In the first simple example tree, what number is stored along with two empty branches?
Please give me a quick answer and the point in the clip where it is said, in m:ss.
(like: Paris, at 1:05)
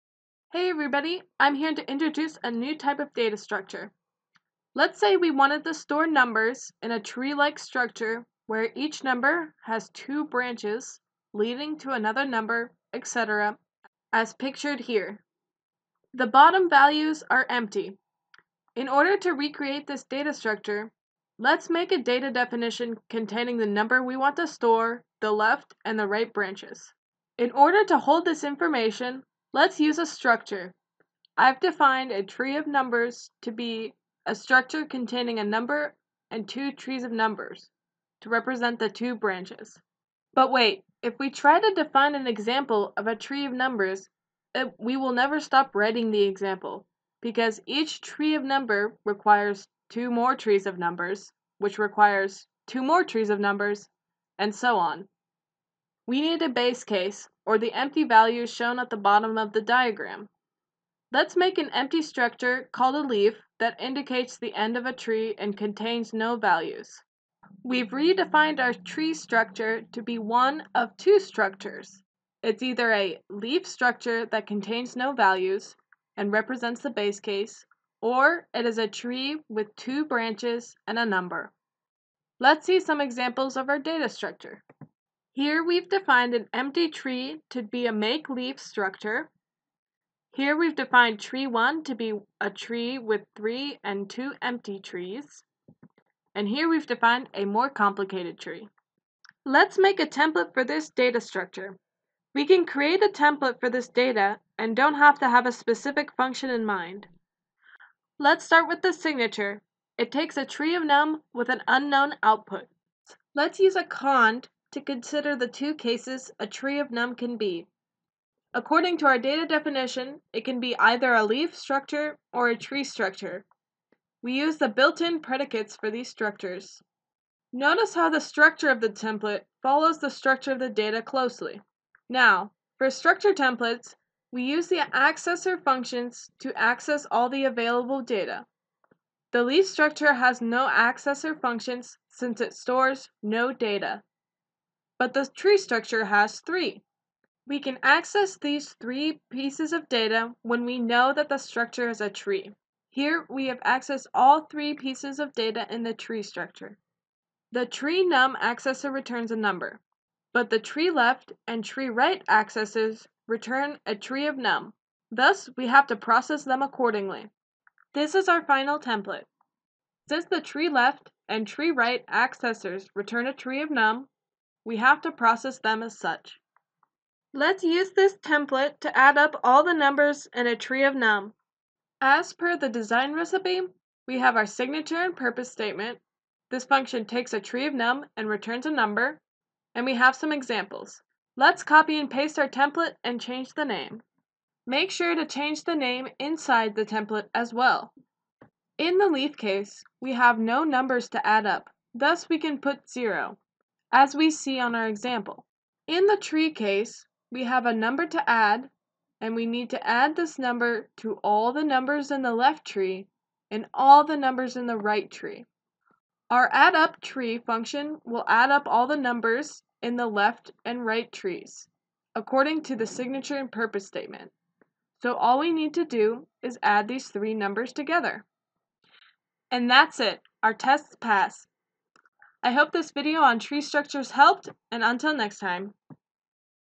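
3, at 1:33.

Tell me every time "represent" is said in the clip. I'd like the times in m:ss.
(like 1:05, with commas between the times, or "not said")
0:38, 1:16.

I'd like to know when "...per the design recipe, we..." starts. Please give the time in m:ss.
3:02.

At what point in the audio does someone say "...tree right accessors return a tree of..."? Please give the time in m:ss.
2:51.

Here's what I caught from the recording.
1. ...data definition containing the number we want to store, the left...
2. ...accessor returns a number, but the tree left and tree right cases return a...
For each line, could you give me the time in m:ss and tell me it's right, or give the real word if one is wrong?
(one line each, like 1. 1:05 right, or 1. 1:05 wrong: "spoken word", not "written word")
1. 0:22 right
2. 2:38 wrong: "accesses", not "cases".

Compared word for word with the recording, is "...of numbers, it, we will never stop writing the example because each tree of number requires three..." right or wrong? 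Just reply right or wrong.
wrong.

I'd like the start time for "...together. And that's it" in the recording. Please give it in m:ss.
3:47.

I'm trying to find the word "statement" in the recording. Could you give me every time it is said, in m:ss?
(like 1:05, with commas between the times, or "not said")
3:05, 3:43.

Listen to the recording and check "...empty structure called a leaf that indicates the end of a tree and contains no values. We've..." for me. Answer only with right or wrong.
right.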